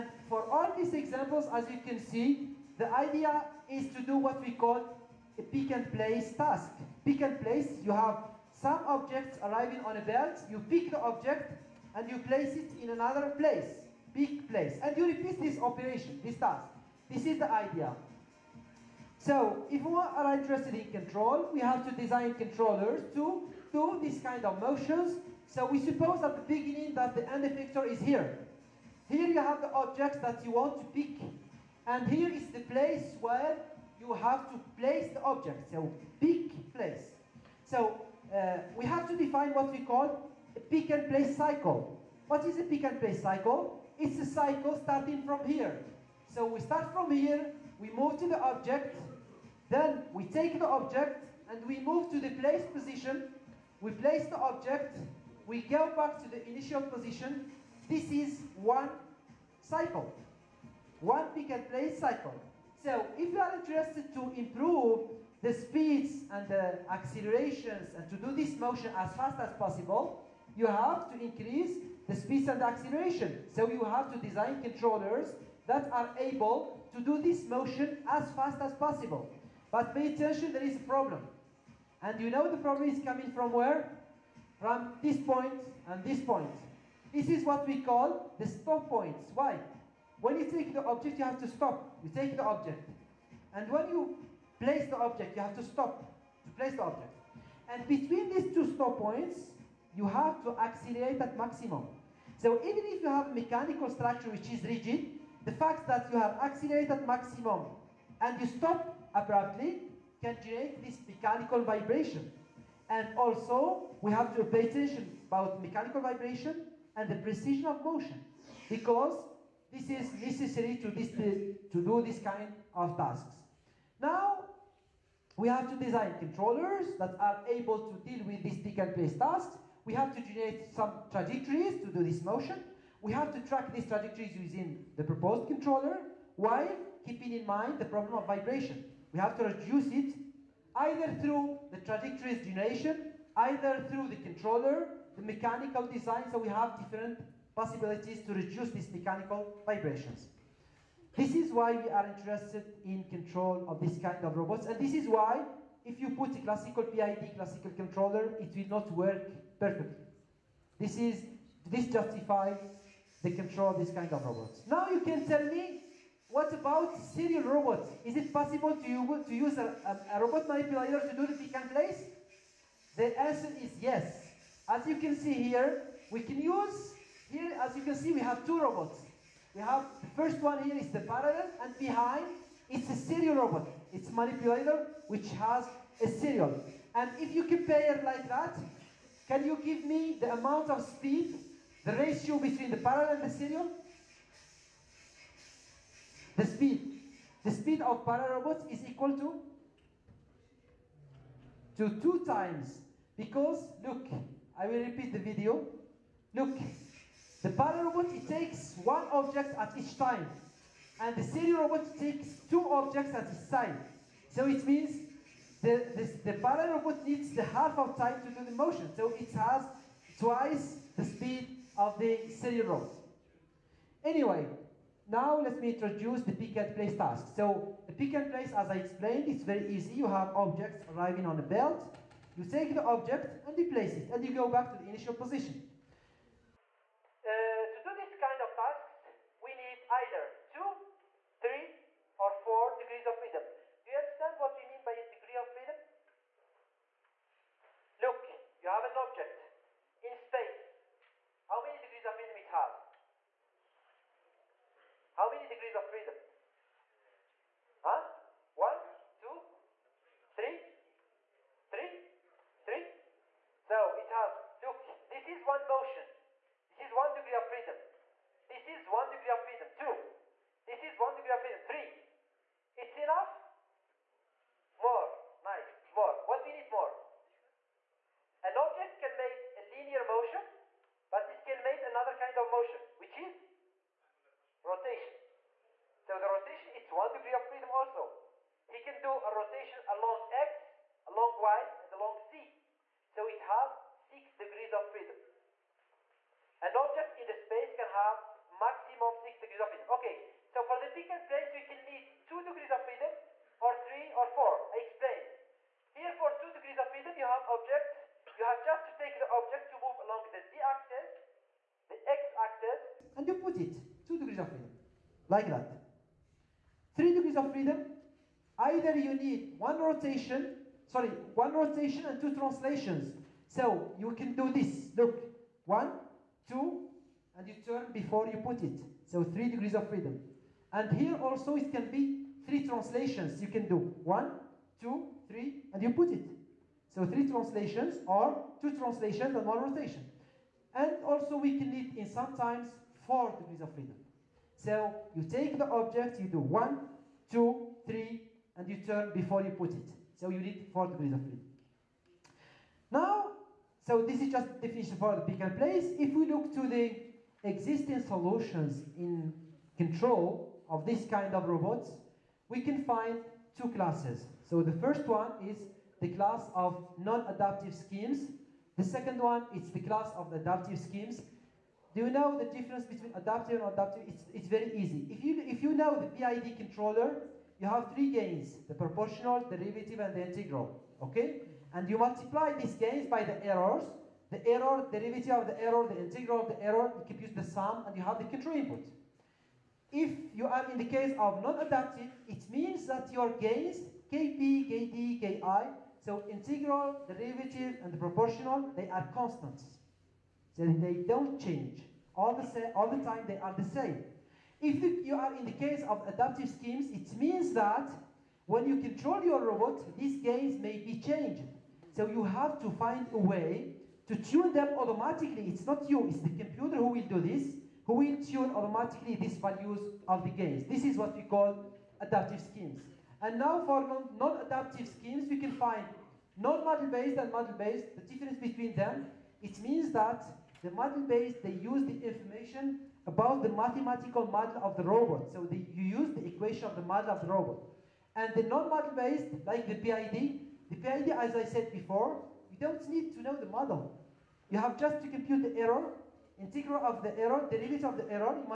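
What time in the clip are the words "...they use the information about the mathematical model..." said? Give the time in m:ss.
7:11.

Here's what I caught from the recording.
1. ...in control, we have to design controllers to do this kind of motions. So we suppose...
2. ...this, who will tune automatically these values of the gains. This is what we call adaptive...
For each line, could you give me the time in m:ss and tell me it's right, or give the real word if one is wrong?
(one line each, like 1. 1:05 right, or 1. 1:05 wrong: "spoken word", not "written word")
1. 0:20 right
2. 6:57 right.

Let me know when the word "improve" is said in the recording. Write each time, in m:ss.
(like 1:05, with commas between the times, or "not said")
1:04.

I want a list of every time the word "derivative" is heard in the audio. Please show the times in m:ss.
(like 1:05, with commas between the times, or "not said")
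6:19, 6:24, 6:37, 7:27.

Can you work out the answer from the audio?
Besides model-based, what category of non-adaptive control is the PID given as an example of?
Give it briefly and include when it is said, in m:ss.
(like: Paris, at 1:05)
Non-model-based, at 7:06.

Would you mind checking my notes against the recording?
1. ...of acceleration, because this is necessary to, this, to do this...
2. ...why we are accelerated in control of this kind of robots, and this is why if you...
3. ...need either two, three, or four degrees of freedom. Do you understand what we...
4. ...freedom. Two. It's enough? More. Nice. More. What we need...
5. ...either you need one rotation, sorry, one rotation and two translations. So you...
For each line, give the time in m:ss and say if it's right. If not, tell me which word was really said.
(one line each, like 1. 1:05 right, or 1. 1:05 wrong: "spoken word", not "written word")
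1. 1:57 wrong: "motion", not "acceleration"
2. 2:31 wrong: "interested", not "accelerated"
3. 3:59 right
4. 4:31 wrong: "Three", not "Two"
5. 5:18 right.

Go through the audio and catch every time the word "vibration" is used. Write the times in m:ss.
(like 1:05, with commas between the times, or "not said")
1:51, 1:56, 2:18, 2:29.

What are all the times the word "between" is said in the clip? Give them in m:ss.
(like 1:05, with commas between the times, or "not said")
1:37, 3:12, 6:12, 7:08.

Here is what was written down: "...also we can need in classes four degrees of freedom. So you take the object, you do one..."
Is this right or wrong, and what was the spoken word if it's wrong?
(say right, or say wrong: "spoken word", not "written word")
wrong: "sometimes", not "classes".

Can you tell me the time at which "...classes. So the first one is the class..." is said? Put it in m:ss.
6:03.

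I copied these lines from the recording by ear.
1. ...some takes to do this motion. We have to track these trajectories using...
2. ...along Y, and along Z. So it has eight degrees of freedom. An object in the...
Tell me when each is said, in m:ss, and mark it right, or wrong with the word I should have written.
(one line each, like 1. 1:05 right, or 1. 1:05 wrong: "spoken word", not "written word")
1. 2:10 wrong: "trajectories", not "takes"
2. 4:51 wrong: "six", not "eight".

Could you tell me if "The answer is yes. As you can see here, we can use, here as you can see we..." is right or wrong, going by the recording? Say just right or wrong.
right.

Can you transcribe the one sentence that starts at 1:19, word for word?
But pay attention, there is a problem.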